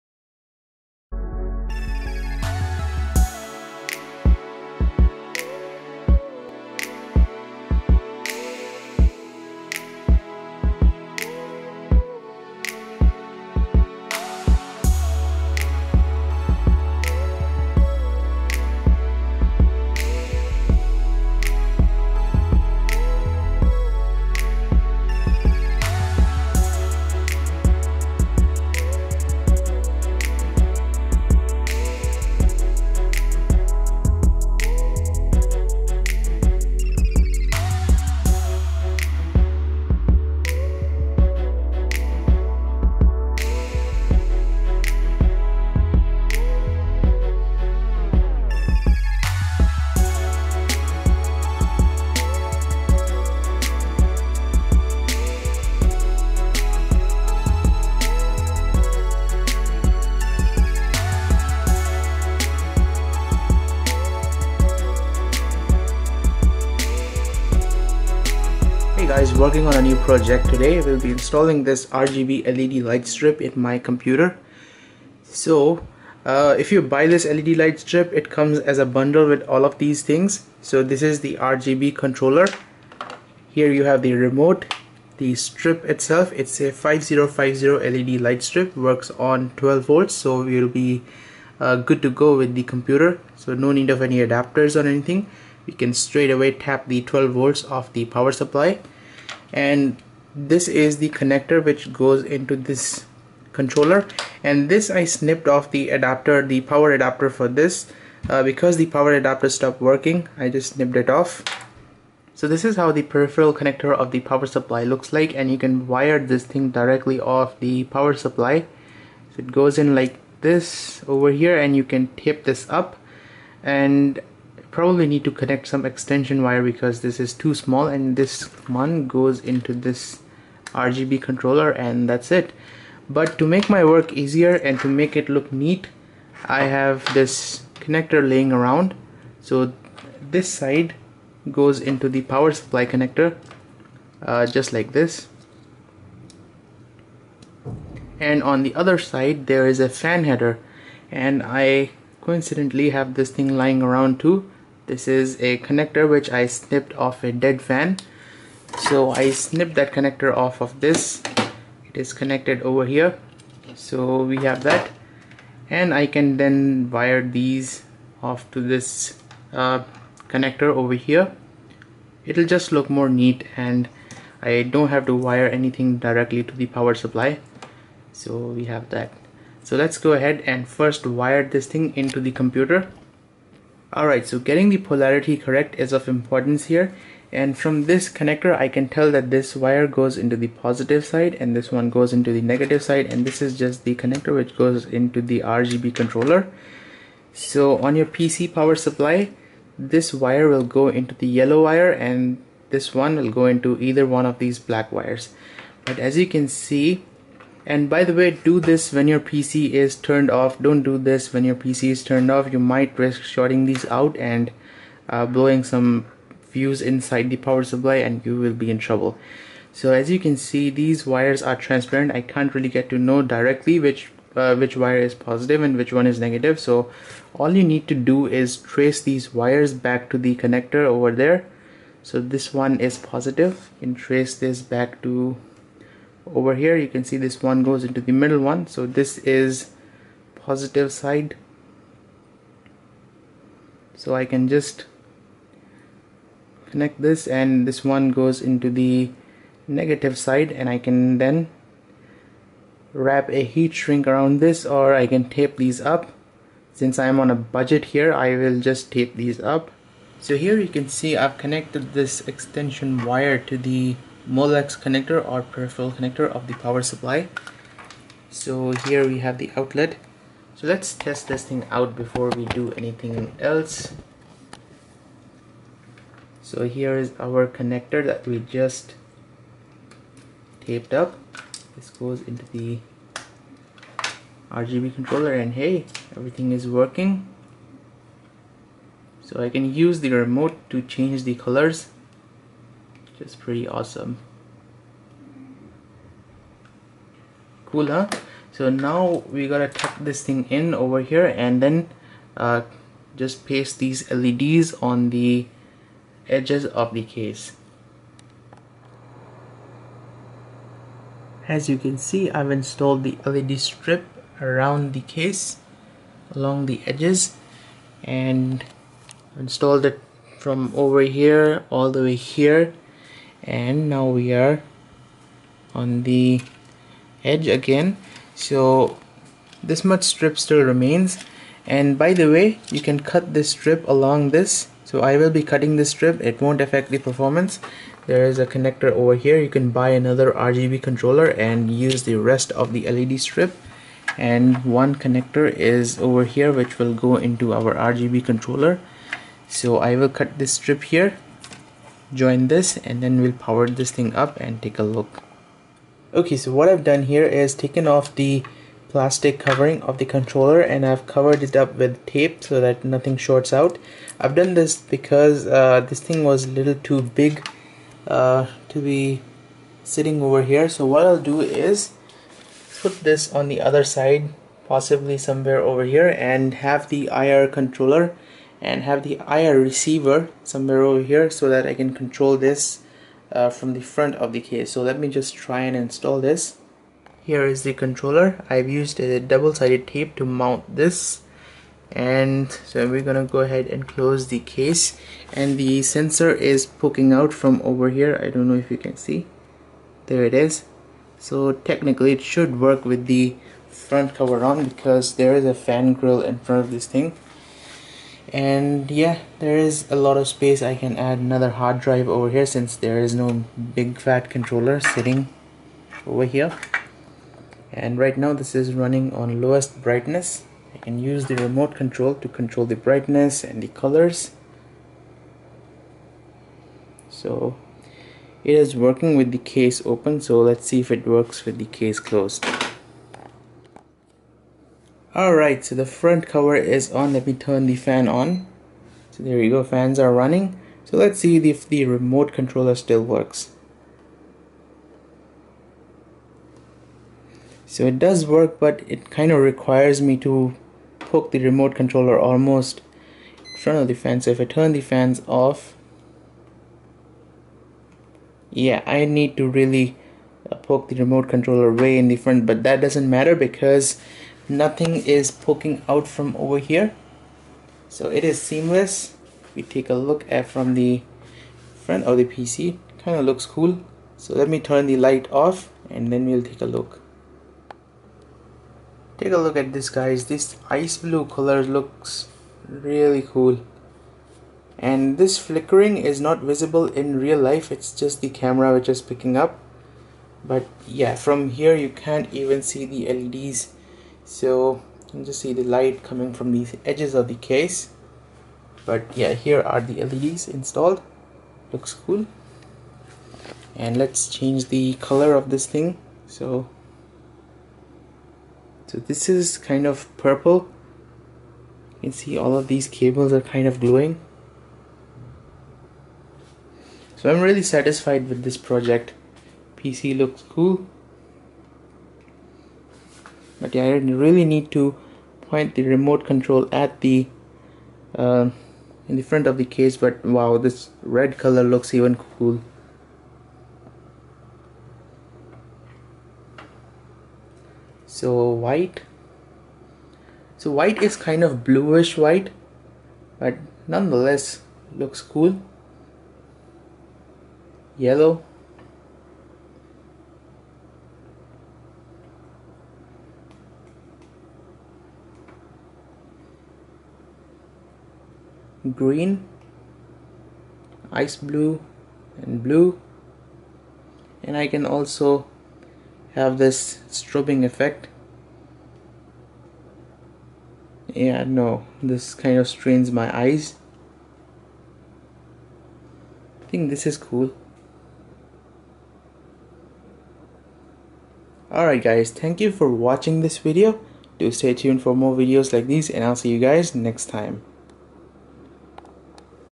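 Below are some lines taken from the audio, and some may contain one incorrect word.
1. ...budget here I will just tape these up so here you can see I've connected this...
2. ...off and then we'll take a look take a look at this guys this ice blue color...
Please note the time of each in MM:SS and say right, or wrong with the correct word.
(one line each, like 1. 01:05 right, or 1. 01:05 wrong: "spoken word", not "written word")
1. 04:17 right
2. 07:55 right.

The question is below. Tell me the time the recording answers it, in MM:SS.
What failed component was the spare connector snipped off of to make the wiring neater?
02:37.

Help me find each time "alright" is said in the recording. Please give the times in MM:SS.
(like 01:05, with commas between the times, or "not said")
03:03, 07:15, 09:41.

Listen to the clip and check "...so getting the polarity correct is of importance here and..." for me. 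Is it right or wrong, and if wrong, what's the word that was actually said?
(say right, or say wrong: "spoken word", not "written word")
right.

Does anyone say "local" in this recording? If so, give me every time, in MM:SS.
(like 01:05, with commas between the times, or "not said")
not said.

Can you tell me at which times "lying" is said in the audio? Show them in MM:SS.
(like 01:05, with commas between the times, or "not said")
02:33.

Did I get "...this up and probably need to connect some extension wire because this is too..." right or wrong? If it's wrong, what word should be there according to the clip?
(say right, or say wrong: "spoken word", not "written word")
right.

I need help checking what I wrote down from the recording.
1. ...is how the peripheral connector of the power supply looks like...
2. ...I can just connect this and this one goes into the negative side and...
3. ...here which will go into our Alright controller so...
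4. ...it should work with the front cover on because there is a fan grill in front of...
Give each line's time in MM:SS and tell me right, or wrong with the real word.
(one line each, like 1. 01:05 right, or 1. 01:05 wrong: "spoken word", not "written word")
1. 01:52 right
2. 04:04 right
3. 05:46 wrong: "RGB", not "Alright"
4. 06:42 right.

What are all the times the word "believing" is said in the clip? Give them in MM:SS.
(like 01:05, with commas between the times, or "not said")
not said.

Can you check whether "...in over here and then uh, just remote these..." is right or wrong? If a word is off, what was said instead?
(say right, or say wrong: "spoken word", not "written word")
wrong: "paste", not "remote".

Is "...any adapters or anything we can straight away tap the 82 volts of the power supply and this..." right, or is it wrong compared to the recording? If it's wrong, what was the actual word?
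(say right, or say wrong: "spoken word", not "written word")
wrong: "12", not "82".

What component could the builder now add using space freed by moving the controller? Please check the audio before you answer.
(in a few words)
another hard drive.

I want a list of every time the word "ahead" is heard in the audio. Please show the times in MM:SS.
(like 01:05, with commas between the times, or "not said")
03:00, 06:33.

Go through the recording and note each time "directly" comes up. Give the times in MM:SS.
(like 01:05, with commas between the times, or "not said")
01:56, 02:55, 03:43.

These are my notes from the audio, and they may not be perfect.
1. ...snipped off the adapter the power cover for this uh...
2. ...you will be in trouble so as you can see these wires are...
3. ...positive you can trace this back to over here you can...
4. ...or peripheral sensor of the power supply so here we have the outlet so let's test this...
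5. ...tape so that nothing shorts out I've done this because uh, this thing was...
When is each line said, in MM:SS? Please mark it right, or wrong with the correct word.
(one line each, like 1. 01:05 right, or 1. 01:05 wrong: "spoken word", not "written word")
1. 01:45 wrong: "adapter", not "cover"
2. 03:38 right
3. 03:53 right
4. 04:25 wrong: "connector", not "sensor"
5. 06:02 right.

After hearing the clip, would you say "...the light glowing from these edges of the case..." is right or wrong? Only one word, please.
wrong.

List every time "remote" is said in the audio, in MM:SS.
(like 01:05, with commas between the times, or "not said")
01:24, 04:50, 07:01, 07:21, 07:31, 07:40, 08:45.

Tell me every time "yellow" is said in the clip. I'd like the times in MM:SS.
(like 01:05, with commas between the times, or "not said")
03:21, 09:07.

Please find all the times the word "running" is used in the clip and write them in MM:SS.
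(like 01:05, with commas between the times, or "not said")
06:58, 07:20.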